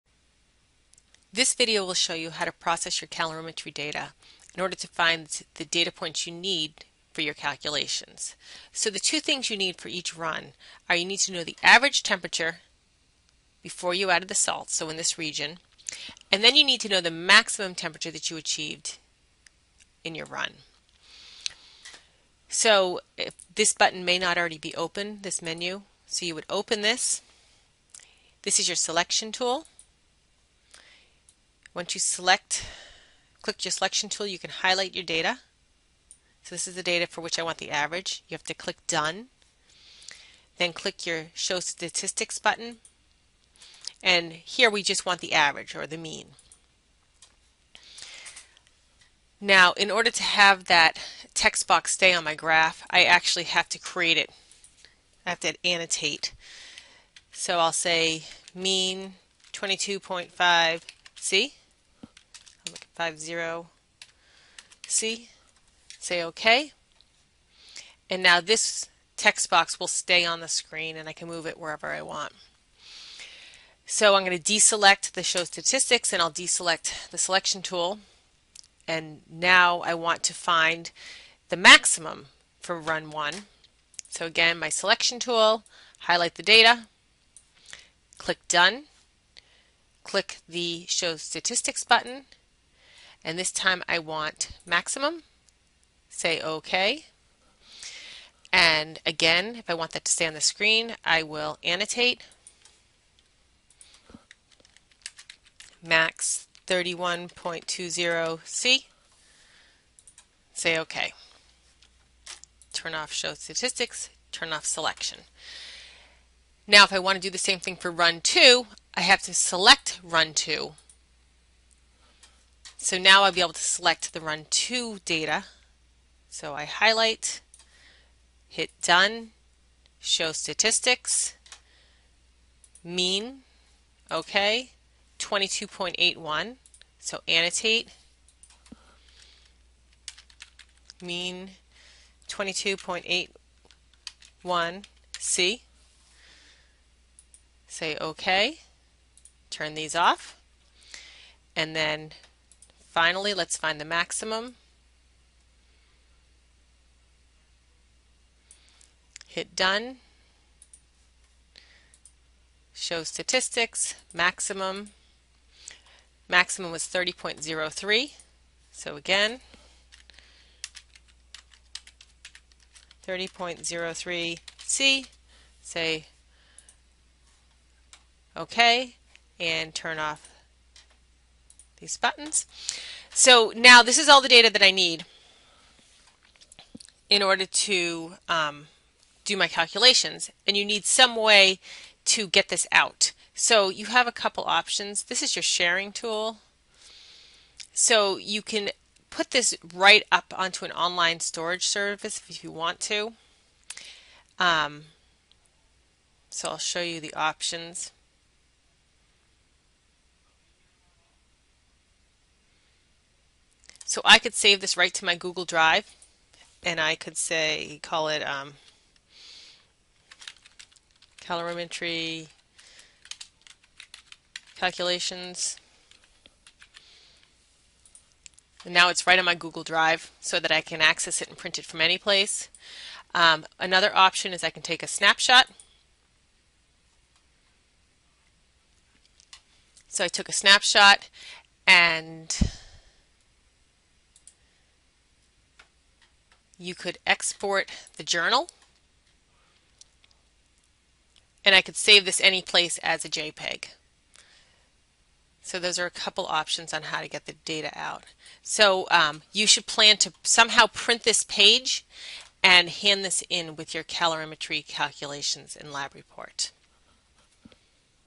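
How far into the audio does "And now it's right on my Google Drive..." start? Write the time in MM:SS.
03:48.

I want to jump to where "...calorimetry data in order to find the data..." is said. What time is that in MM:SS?
00:03.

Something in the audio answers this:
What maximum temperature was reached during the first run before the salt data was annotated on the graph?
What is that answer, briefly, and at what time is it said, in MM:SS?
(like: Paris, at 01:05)
31.20 C, at 01:46.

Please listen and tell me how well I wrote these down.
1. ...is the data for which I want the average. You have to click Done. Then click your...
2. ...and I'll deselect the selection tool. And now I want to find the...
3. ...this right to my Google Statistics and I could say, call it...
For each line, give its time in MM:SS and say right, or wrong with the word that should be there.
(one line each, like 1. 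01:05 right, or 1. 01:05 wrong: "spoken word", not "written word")
1. 00:36 right
2. 01:16 right
3. 03:34 wrong: "Drive", not "Statistics".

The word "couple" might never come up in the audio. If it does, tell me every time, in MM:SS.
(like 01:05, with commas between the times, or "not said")
03:14, 04:15.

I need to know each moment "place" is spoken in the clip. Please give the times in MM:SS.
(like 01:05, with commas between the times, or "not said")
03:51, 04:12.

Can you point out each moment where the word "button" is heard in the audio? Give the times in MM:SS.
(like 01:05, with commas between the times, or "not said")
00:23, 00:42, 01:31, 03:01.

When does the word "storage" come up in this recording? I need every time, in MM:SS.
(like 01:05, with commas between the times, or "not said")
03:21.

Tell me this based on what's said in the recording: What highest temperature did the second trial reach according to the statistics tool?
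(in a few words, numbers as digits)
30.03.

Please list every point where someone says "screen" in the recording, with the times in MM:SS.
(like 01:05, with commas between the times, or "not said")
01:10, 01:40.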